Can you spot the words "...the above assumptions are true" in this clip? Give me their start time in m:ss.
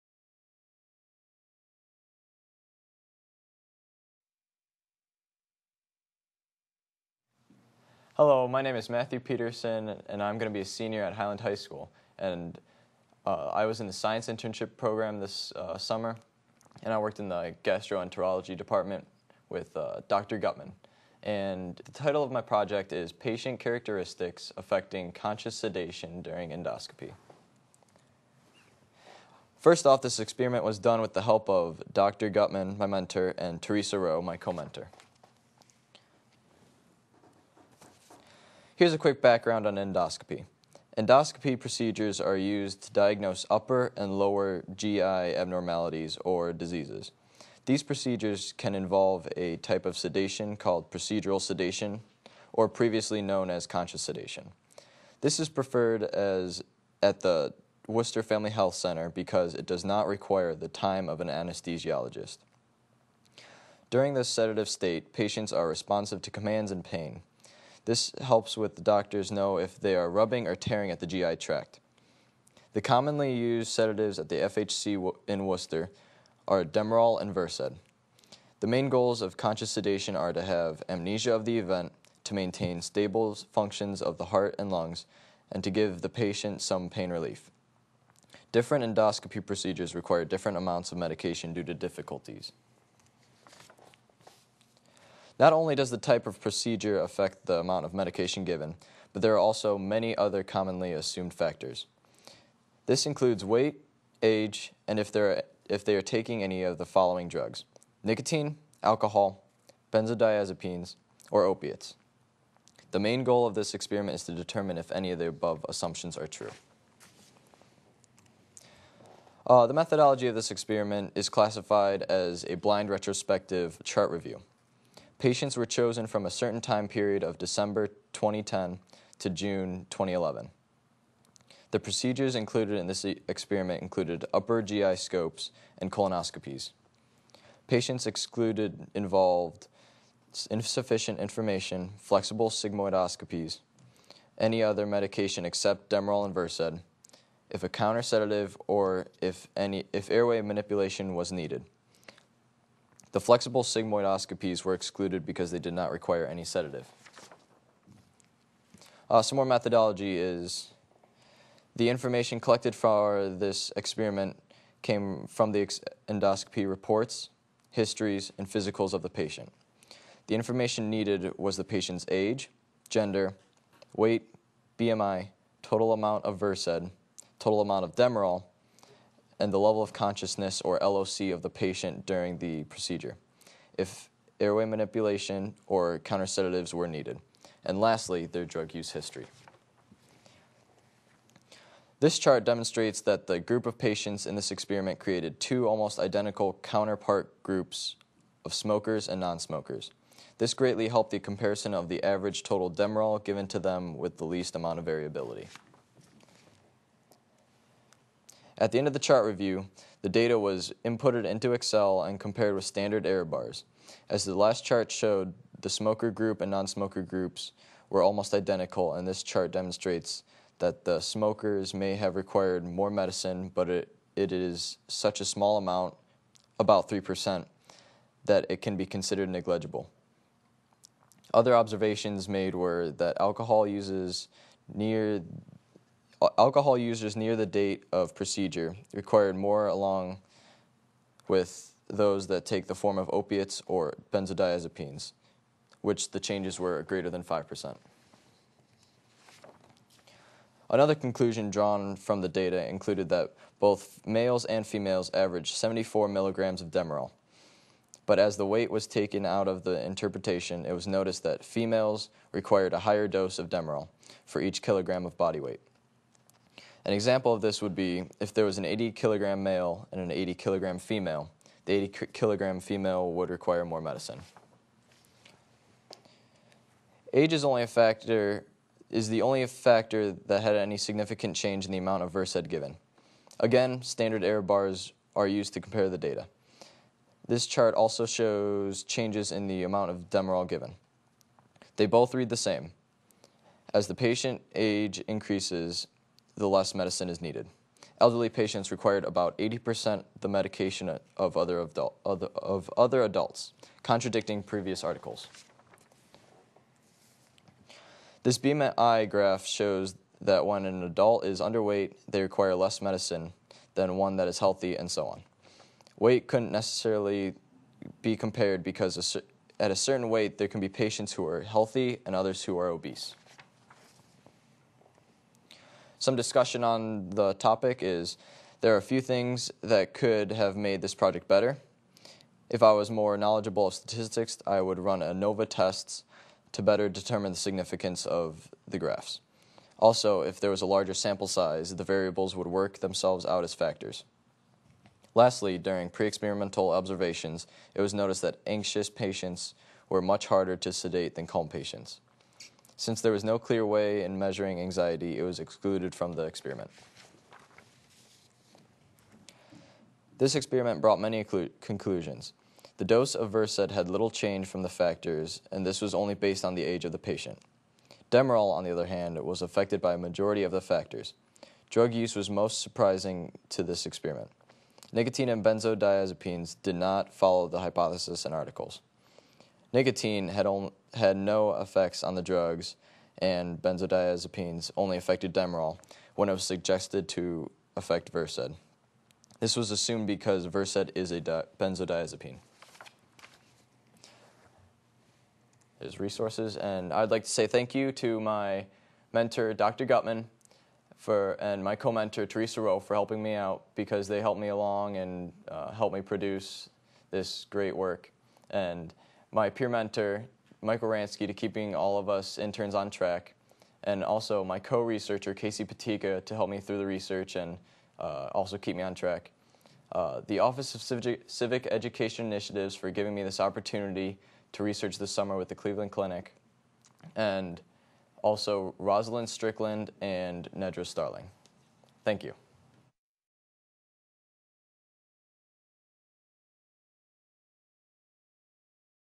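1:55.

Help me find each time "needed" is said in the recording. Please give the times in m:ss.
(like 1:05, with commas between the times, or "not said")
2:31, 2:50, 3:06, 4:57.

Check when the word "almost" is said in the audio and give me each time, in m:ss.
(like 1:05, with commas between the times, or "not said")
3:15, 3:38.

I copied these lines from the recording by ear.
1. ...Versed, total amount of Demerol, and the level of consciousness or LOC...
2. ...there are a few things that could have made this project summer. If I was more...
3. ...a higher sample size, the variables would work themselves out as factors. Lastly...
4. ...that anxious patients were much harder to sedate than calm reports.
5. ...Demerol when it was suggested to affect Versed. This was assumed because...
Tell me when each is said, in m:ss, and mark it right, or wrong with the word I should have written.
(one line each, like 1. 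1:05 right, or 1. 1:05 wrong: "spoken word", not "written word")
1. 2:56 right
2. 5:28 wrong: "better", not "summer"
3. 5:40 wrong: "larger", not "higher"
4. 5:48 wrong: "patients", not "reports"
5. 6:25 right.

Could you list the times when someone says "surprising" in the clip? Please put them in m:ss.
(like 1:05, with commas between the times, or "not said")
6:12.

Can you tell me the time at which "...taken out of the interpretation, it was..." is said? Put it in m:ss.
4:18.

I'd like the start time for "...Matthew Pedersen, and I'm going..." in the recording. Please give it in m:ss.
0:08.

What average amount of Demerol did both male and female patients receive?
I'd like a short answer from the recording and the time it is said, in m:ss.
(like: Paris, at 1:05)
74 milligrams, at 4:15.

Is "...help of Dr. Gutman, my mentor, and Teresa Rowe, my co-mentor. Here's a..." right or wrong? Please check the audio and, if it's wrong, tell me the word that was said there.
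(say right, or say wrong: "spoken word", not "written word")
right.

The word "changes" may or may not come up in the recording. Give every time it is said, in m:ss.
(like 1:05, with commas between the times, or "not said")
4:06, 4:41, 4:48, 6:04.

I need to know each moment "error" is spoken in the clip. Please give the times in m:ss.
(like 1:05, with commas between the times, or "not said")
3:33, 4:44.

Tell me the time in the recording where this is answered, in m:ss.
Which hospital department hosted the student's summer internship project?
0:17.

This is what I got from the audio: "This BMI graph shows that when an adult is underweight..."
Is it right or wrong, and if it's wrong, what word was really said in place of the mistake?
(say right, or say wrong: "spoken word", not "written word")
right.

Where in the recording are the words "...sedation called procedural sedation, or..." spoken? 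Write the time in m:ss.
0:49.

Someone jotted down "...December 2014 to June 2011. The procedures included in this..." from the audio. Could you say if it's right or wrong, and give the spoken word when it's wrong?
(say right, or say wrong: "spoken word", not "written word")
wrong: "2010", not "2014".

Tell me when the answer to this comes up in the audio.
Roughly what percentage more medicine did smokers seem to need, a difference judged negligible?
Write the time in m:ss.
3:46.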